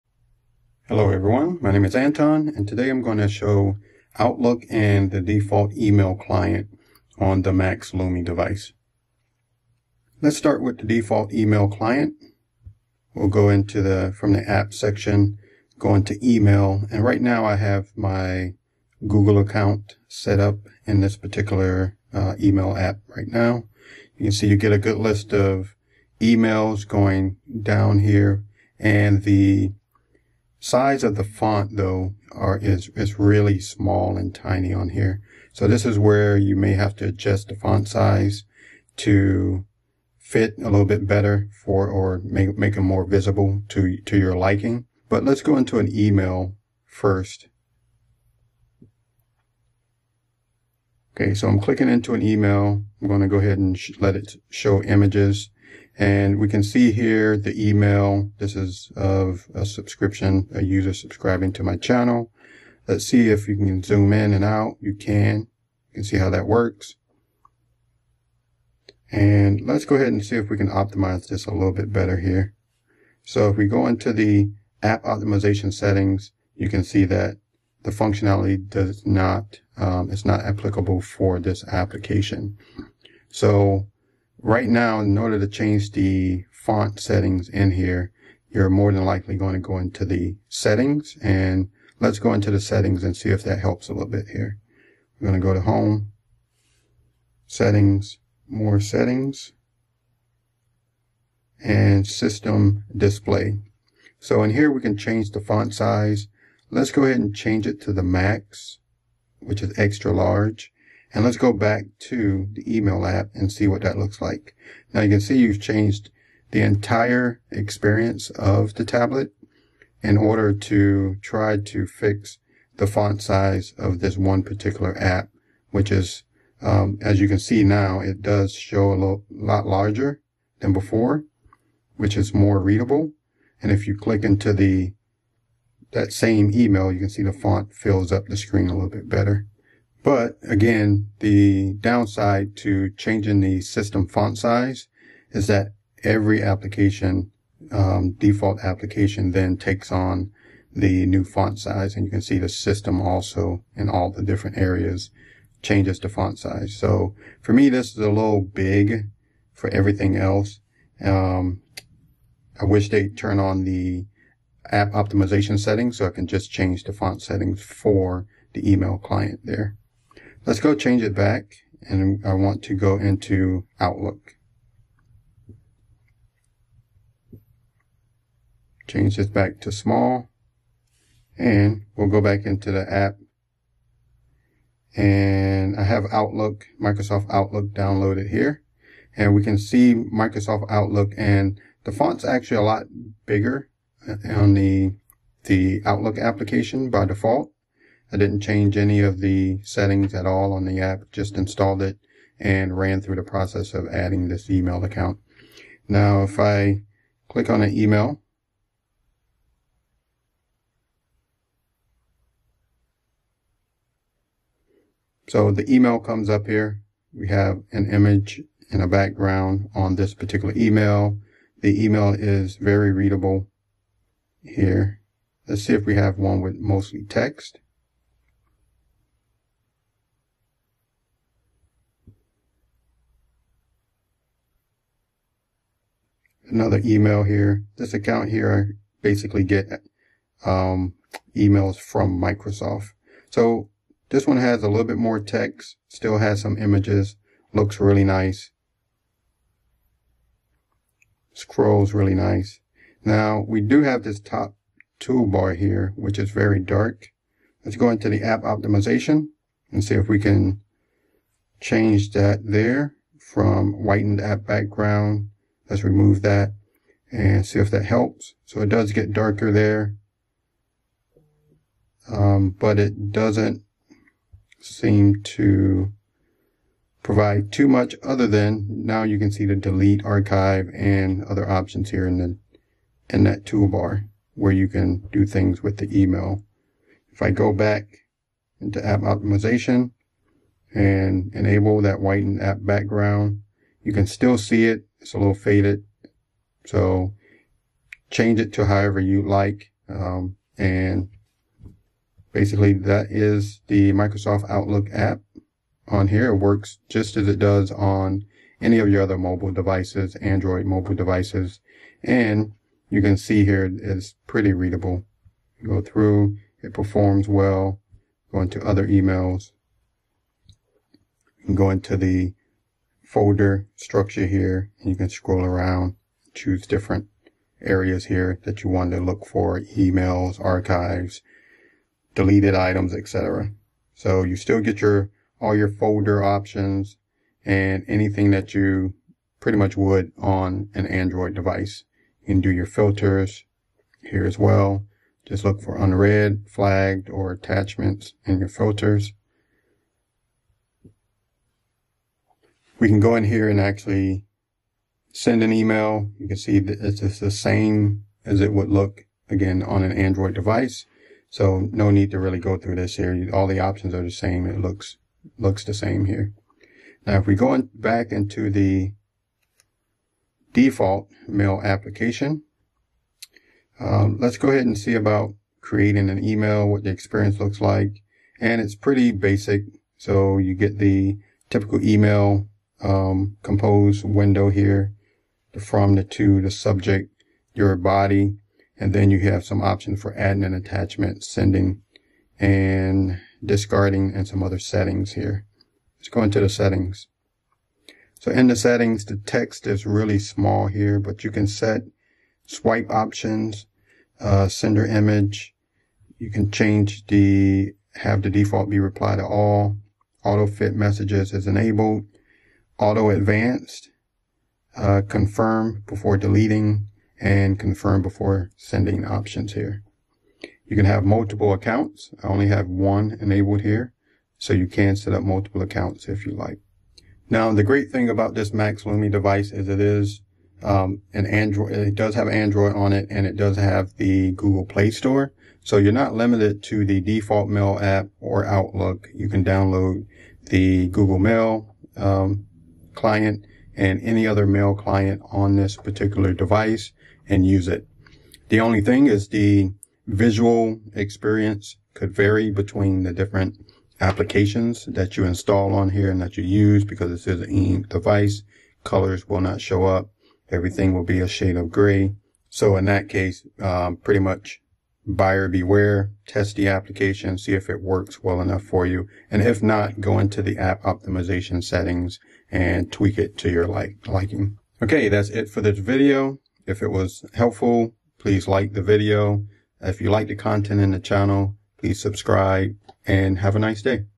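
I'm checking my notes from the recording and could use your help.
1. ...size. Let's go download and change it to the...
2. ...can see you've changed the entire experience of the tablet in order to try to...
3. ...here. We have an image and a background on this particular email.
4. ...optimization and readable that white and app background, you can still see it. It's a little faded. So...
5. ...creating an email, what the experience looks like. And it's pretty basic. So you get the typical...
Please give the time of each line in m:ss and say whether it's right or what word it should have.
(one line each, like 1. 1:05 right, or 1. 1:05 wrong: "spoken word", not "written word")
1. 1:45 wrong: "ahead", not "download"
2. 1:55 right
3. 3:36 right
4. 4:49 wrong: "enable", not "readable"
5. 6:15 right.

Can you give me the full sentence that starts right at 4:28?
So it does get darker there.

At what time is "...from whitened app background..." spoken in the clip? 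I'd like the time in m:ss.
4:23.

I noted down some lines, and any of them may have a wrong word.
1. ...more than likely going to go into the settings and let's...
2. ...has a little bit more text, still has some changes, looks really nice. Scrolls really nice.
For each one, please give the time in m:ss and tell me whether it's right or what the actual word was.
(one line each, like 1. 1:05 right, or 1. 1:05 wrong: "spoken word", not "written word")
1. 1:28 right
2. 4:04 wrong: "images", not "changes".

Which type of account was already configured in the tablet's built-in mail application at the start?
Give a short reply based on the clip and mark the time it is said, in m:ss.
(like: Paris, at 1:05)
Google account, at 0:19.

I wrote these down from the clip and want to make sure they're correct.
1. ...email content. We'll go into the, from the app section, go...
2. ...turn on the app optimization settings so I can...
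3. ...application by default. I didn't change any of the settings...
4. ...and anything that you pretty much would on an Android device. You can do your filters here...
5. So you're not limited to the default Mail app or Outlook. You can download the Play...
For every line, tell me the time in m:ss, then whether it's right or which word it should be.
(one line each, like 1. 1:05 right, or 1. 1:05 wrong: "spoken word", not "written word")
1. 0:11 wrong: "client", not "content"
2. 2:43 right
3. 3:16 right
4. 5:37 right
5. 7:15 wrong: "Google", not "Play".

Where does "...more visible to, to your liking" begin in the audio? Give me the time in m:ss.
0:42.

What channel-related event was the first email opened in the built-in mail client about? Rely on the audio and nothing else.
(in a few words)
A user subscribing.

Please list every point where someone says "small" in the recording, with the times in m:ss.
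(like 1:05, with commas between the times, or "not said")
0:33, 2:59, 6:40.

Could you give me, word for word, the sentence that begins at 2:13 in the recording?
And if you click into the that same email, you can see the font fills up the screen a little bit better.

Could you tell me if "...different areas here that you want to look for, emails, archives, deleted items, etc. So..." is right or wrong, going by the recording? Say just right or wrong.
right.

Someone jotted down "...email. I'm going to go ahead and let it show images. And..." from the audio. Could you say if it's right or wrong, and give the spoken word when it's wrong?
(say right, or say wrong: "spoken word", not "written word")
right.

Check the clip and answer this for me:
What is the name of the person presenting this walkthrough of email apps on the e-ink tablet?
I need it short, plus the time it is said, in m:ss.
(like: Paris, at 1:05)
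Antone, at 0:01.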